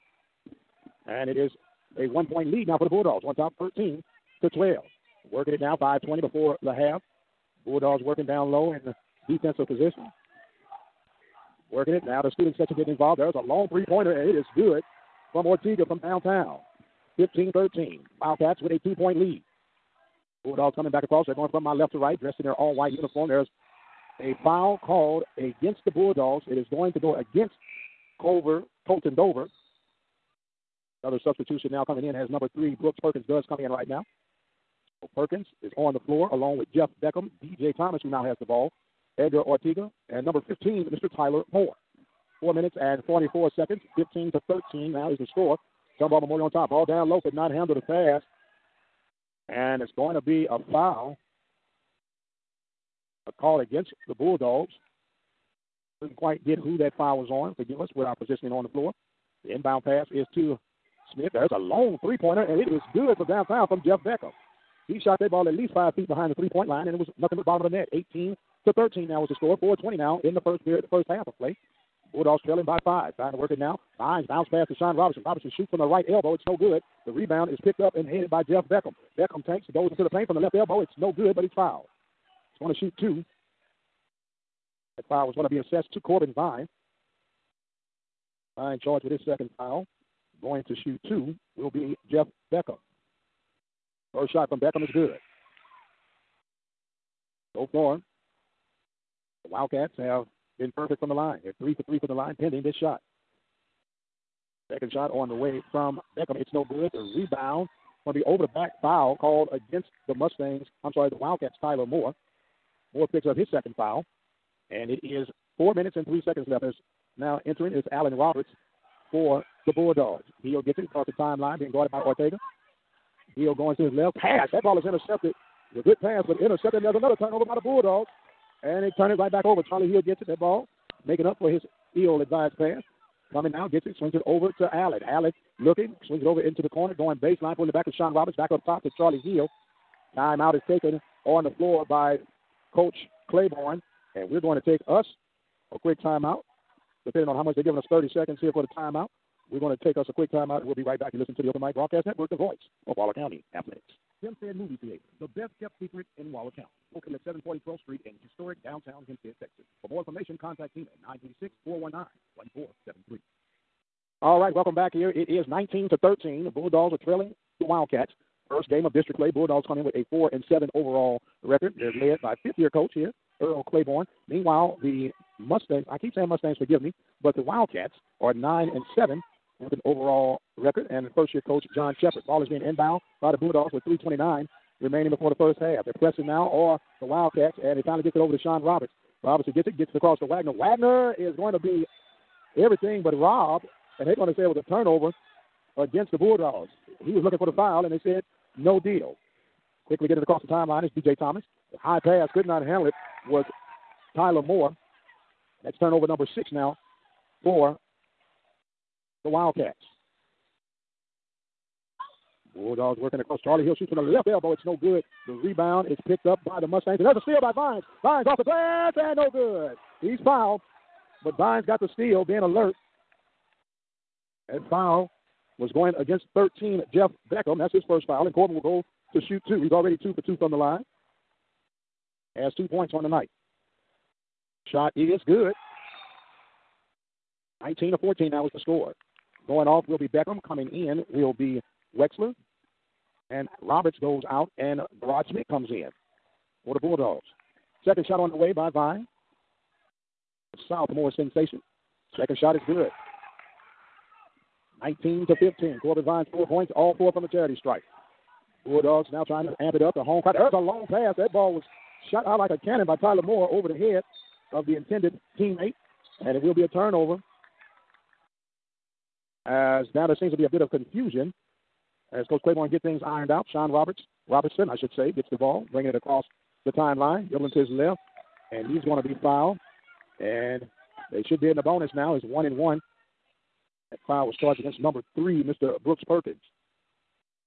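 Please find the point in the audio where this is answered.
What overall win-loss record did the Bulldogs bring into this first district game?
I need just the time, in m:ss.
2:50.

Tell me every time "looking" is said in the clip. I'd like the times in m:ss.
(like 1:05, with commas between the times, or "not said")
2:15, 3:17.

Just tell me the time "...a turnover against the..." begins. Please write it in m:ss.
3:14.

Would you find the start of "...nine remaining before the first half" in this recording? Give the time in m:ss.
3:04.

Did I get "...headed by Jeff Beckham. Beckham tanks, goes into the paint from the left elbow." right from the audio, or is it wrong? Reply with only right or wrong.
right.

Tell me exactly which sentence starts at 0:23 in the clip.
There's a foul called against the Bulldogs.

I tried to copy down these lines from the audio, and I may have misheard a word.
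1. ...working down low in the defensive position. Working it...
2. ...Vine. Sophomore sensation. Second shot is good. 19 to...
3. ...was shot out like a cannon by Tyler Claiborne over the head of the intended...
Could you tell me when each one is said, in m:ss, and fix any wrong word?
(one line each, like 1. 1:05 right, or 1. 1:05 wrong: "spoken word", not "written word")
1. 0:08 right
2. 4:08 right
3. 4:21 wrong: "Moore", not "Claiborne".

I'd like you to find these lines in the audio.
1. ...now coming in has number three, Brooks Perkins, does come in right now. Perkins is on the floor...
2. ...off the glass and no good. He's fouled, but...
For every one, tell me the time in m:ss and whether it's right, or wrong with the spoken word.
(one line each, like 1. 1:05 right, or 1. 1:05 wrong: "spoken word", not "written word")
1. 0:31 right
2. 3:38 right.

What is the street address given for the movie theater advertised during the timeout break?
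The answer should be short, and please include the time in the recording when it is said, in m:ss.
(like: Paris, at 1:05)
740 12th Street, at 2:37.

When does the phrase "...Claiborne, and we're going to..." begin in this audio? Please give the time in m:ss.
2:23.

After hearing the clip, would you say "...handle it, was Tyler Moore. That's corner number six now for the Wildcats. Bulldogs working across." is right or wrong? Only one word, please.
wrong.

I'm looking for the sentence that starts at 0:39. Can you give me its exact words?
Edgar Ortega, and number 15, Mr.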